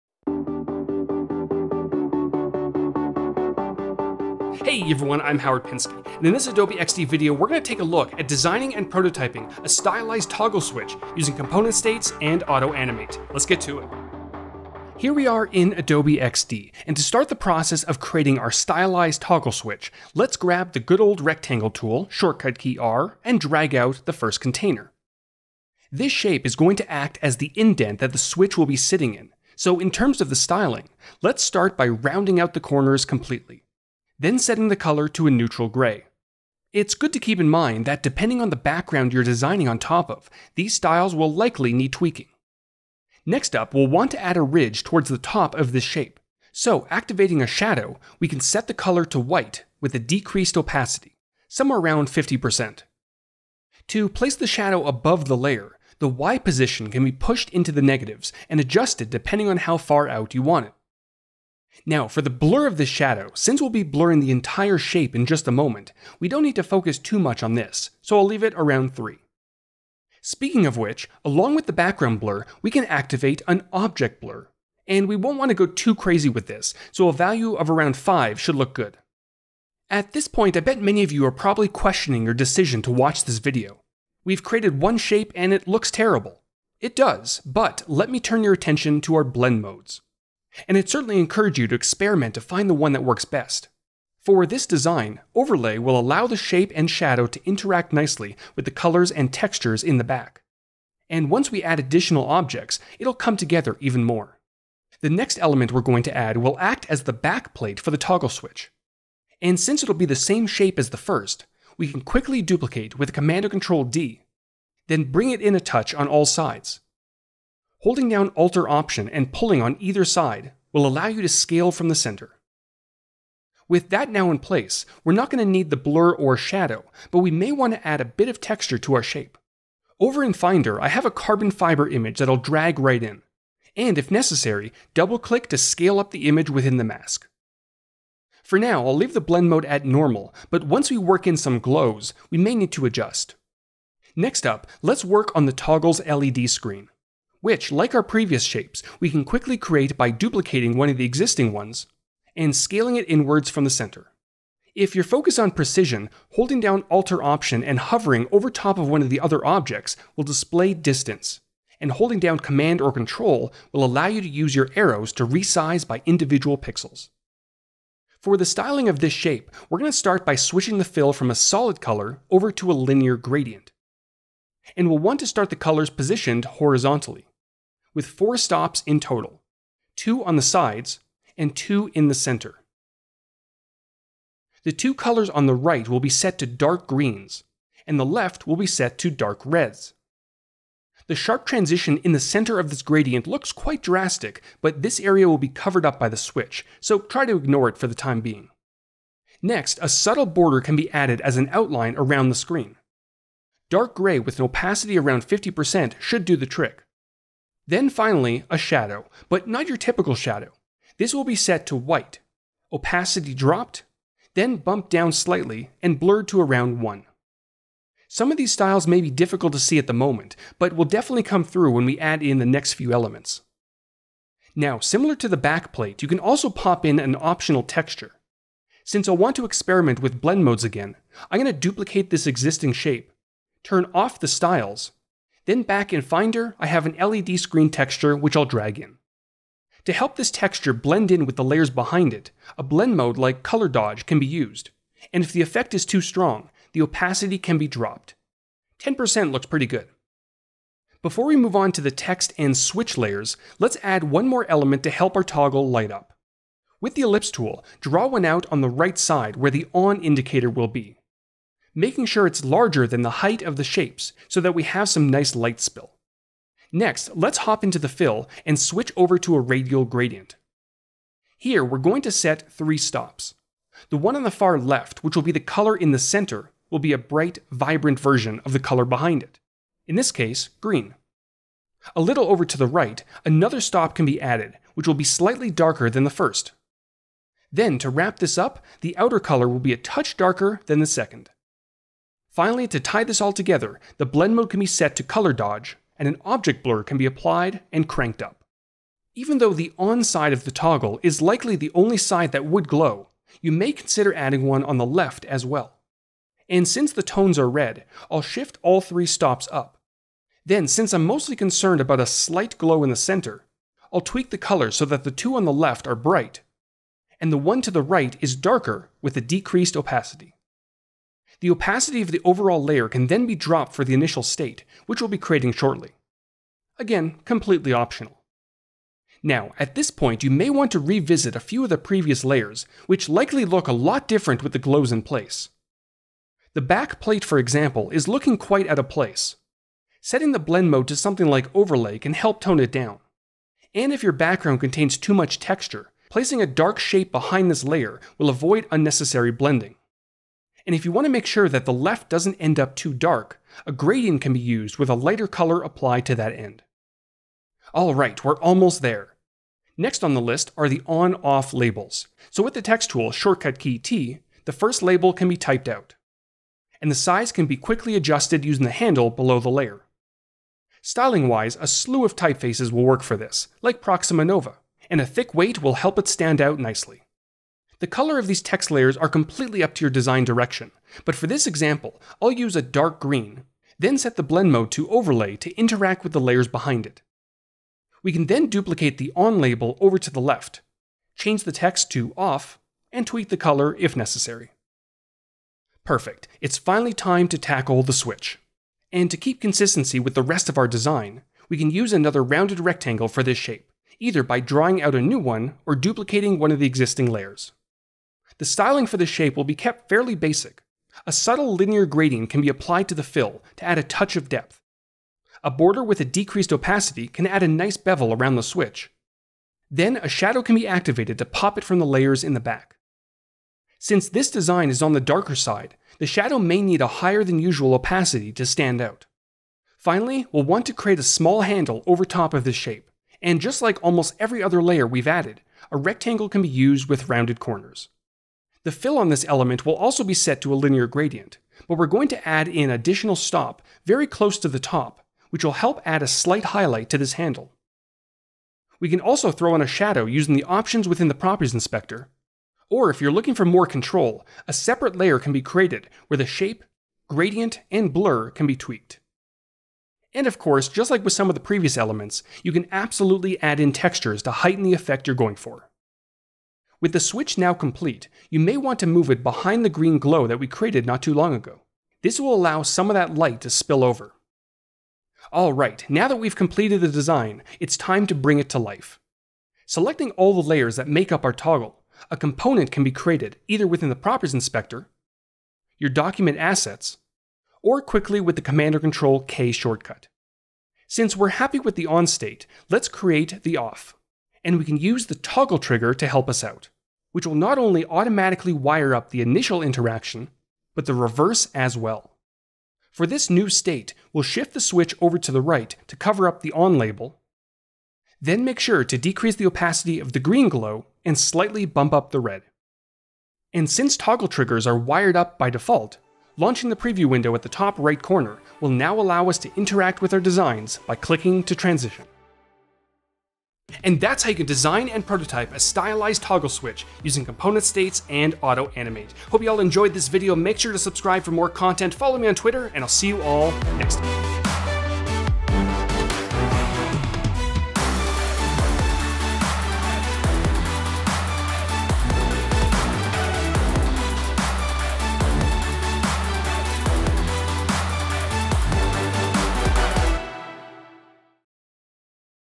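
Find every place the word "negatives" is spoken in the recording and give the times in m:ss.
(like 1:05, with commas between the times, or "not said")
0:57.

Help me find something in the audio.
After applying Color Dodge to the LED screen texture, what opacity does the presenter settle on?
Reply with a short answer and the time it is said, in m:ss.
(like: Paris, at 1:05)
10%, at 4:08.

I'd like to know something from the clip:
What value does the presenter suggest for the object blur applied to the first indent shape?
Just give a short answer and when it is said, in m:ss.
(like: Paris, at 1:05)
5, at 1:17.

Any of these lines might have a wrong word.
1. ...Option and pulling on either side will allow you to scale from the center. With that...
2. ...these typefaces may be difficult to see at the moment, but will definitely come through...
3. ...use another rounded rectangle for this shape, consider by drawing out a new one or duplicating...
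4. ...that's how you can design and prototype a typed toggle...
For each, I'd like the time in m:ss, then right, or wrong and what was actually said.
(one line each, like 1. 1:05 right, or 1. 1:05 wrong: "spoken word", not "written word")
1. 1:58 right
2. 3:38 wrong: "styles", not "typefaces"
3. 6:41 wrong: "either", not "consider"
4. 8:43 wrong: "stylized", not "typed".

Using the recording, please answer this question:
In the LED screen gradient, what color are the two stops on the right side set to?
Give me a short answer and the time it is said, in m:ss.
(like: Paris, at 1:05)
Dark greens, at 3:06.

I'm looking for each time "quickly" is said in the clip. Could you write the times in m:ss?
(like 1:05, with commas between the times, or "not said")
1:52, 2:29, 6:07, 8:07.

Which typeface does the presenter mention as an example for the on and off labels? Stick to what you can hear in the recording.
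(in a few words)
Proxima Nova.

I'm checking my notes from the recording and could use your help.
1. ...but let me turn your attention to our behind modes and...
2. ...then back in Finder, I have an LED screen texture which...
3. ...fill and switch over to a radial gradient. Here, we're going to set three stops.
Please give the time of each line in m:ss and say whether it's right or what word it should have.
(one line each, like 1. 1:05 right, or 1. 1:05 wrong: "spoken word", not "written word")
1. 1:27 wrong: "blend", not "behind"
2. 3:55 right
3. 4:27 right.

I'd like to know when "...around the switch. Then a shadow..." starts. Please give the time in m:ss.
6:58.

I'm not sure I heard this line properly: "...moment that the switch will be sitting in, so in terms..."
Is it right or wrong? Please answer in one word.
wrong.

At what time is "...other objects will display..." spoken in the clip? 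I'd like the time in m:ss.
2:39.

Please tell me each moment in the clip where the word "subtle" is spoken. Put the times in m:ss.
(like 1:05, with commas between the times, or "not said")
3:19, 6:51.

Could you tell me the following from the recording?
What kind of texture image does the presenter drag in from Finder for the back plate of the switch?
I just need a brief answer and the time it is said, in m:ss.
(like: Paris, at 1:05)
Carbon fiber, at 2:11.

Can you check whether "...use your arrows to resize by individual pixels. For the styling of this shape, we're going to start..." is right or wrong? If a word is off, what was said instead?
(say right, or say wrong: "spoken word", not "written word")
right.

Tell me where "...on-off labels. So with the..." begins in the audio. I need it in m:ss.
6:00.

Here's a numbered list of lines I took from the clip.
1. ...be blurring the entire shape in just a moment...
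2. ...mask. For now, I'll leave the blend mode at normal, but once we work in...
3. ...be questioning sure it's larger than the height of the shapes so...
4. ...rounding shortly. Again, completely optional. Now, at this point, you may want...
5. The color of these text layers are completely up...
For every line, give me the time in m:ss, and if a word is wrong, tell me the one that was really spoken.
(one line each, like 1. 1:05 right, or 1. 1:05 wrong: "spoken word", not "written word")
1. 1:03 right
2. 2:16 right
3. 4:20 wrong: "making", not "questioning"
4. 5:25 wrong: "creating", not "rounding"
5. 6:17 right.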